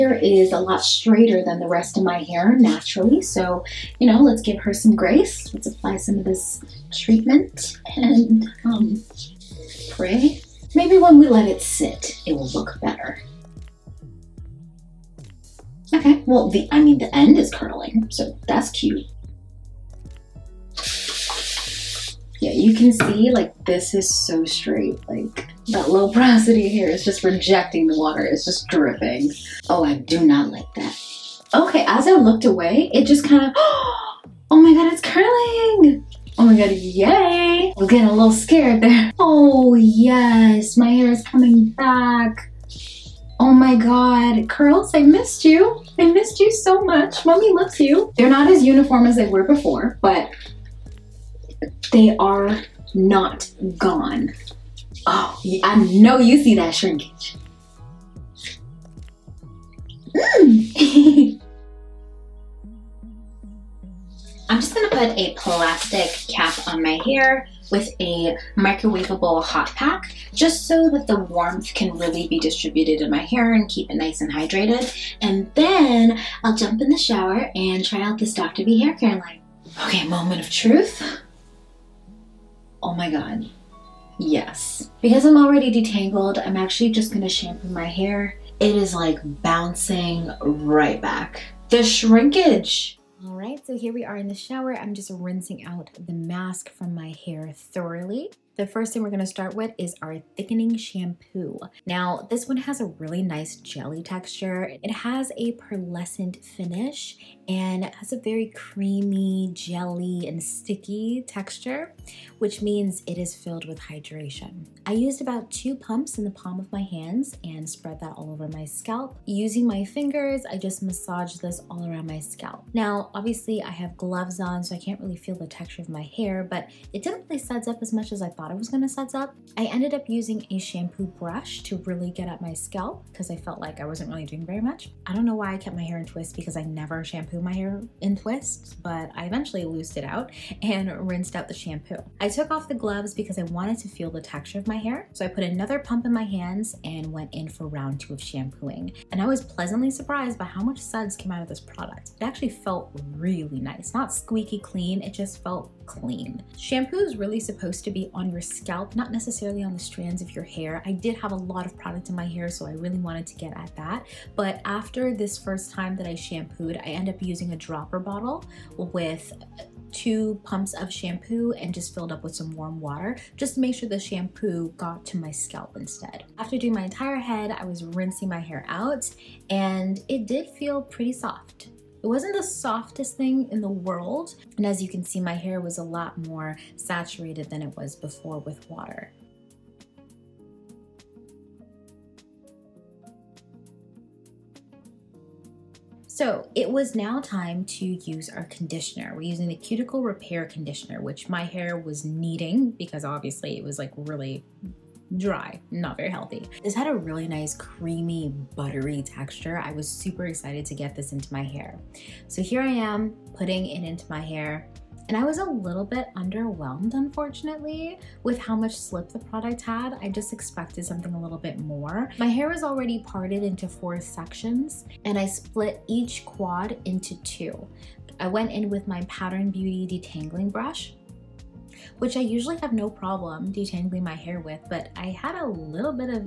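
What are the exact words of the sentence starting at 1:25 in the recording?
Because I'm already detangled, I'm actually just gonna shampoo my hair.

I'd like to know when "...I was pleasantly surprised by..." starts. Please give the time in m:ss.
2:29.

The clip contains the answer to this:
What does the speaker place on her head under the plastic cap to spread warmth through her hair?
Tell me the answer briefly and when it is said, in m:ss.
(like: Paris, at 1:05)
Microwavable hot pack, at 1:08.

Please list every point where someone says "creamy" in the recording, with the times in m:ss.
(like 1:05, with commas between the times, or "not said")
1:48, 3:27.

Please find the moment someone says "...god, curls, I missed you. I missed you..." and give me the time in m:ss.
0:43.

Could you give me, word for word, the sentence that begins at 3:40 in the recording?
I just expected something a little bit more.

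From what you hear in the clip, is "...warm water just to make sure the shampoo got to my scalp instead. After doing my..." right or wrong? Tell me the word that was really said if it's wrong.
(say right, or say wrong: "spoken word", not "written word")
right.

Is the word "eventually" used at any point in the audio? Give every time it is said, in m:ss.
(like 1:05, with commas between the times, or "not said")
2:19.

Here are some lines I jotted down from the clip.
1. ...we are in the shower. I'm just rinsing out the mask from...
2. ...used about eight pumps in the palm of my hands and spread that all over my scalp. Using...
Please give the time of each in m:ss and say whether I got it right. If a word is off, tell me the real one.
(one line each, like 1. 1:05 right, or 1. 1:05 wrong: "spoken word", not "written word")
1. 1:33 right
2. 1:54 wrong: "two", not "eight".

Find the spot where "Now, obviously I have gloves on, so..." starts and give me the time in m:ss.
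2:02.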